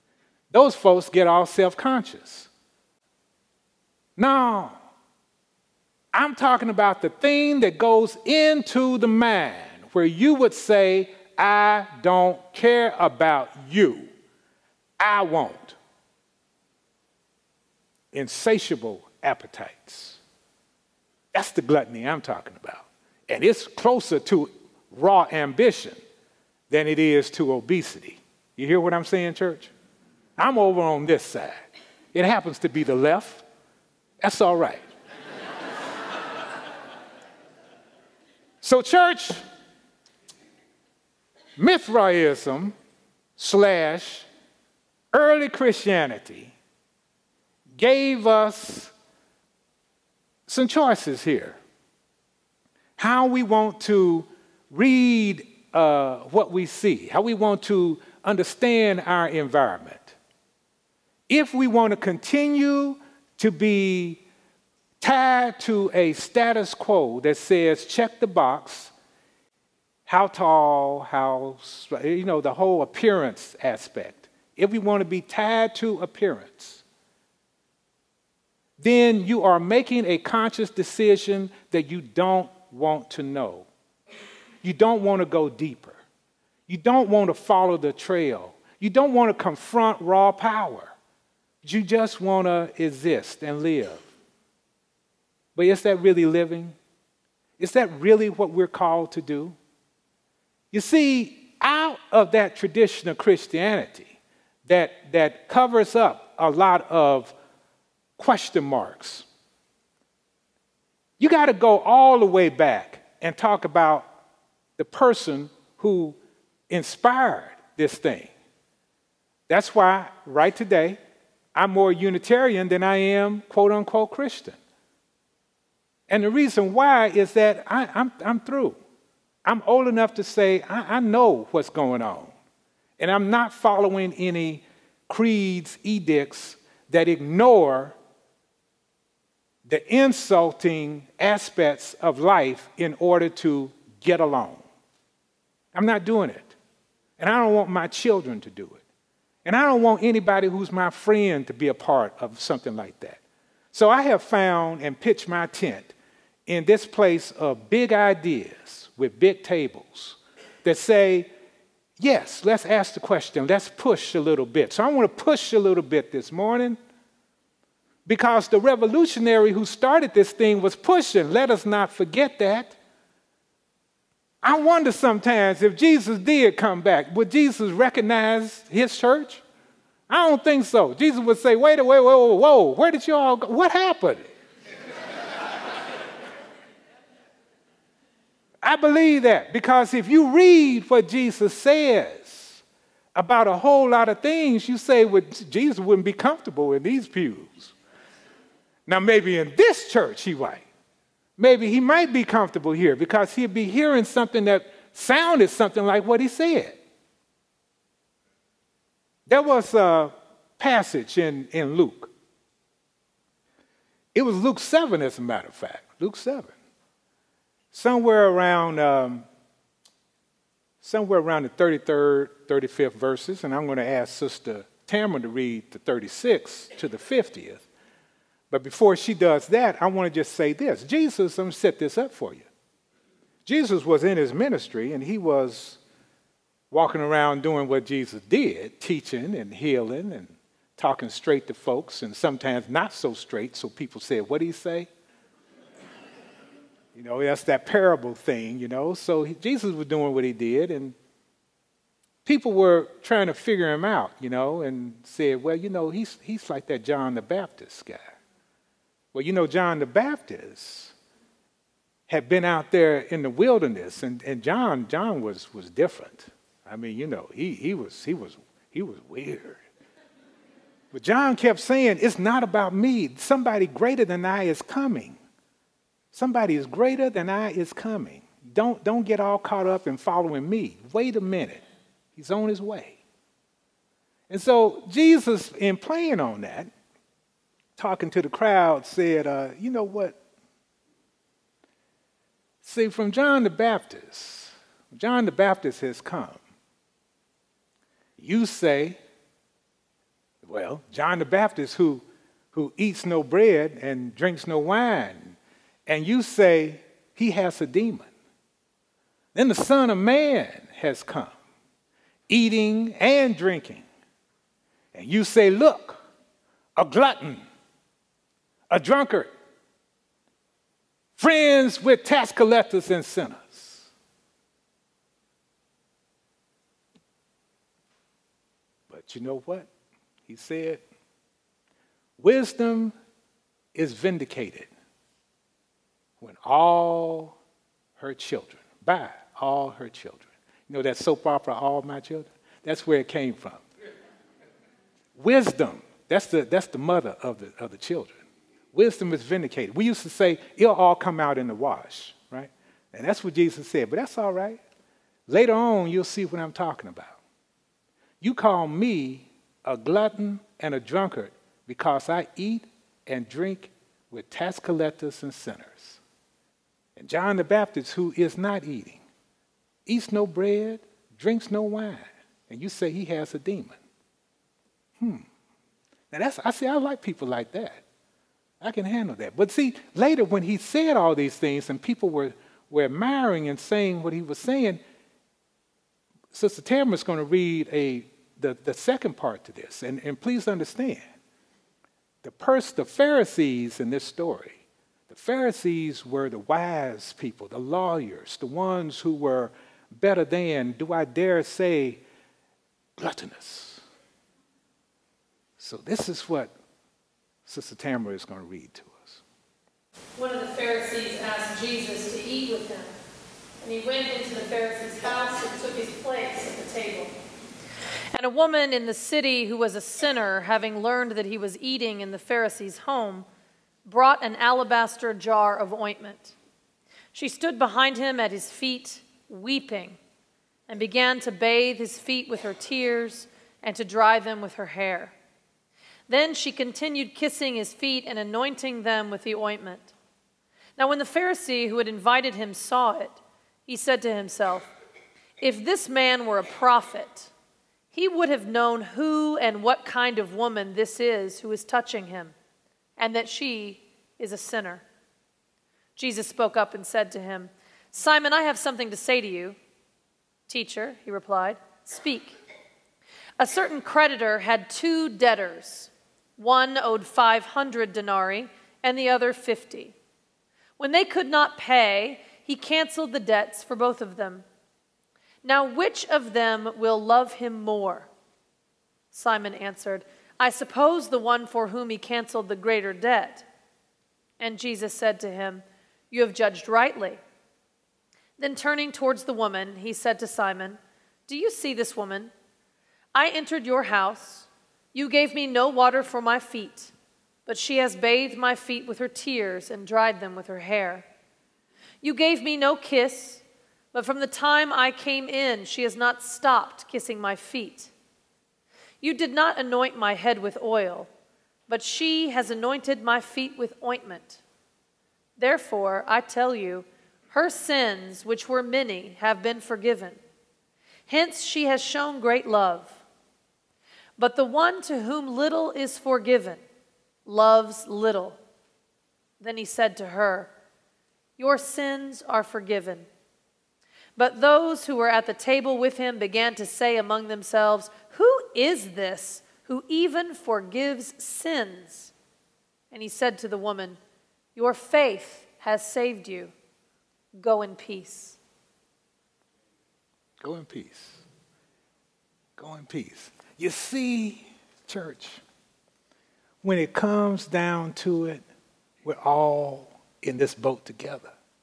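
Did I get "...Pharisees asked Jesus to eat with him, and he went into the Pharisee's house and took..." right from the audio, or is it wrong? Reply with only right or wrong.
right.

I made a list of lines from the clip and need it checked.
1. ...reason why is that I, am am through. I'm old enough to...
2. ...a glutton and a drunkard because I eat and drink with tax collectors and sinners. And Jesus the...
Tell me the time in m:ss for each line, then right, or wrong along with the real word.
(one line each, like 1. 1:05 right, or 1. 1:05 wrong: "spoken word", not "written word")
1. 2:06 right
2. 5:59 wrong: "John", not "Jesus".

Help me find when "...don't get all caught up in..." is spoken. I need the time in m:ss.
4:38.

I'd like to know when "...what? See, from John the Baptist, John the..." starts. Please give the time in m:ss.
4:49.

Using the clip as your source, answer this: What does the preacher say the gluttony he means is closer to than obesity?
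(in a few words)
raw ambition.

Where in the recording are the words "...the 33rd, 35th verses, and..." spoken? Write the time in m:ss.
3:41.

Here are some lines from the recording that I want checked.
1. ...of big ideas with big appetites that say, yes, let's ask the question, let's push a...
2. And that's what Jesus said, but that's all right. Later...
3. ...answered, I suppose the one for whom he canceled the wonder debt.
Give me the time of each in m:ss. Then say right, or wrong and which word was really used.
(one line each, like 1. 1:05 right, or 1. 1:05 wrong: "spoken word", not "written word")
1. 2:37 wrong: "tables", not "appetites"
2. 5:52 right
3. 7:59 wrong: "greater", not "wonder".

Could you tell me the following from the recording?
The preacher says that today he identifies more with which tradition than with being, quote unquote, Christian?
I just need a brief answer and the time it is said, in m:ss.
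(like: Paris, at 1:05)
Unitarian, at 2:01.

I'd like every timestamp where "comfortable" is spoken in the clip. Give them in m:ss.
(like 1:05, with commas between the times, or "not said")
3:16, 3:22.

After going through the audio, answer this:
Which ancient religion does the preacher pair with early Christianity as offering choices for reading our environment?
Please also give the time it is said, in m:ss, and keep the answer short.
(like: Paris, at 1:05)
Mithraism, at 0:41.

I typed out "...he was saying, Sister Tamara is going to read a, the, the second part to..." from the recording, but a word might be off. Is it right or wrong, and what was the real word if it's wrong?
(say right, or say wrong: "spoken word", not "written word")
right.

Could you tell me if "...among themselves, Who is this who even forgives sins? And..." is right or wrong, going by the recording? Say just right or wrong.
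right.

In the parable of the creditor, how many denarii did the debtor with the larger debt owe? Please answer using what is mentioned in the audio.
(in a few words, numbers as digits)
500.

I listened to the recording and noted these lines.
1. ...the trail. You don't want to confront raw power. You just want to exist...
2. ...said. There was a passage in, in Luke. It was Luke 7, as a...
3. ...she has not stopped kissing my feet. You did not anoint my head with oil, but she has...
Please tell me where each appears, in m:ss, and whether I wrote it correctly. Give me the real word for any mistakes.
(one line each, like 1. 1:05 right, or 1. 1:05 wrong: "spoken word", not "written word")
1. 1:27 right
2. 3:26 right
3. 8:25 right.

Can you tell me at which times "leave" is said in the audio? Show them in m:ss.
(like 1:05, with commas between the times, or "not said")
not said.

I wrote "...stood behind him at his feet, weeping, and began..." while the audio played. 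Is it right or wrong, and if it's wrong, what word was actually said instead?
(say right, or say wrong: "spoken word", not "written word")
right.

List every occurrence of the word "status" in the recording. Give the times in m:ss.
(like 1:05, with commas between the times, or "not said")
1:06.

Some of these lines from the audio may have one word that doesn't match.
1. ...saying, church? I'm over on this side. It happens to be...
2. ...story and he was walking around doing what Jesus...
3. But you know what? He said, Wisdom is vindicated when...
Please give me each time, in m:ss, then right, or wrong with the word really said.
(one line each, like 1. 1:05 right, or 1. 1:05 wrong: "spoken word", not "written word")
1. 0:29 right
2. 3:54 wrong: "ministry", not "story"
3. 5:28 right.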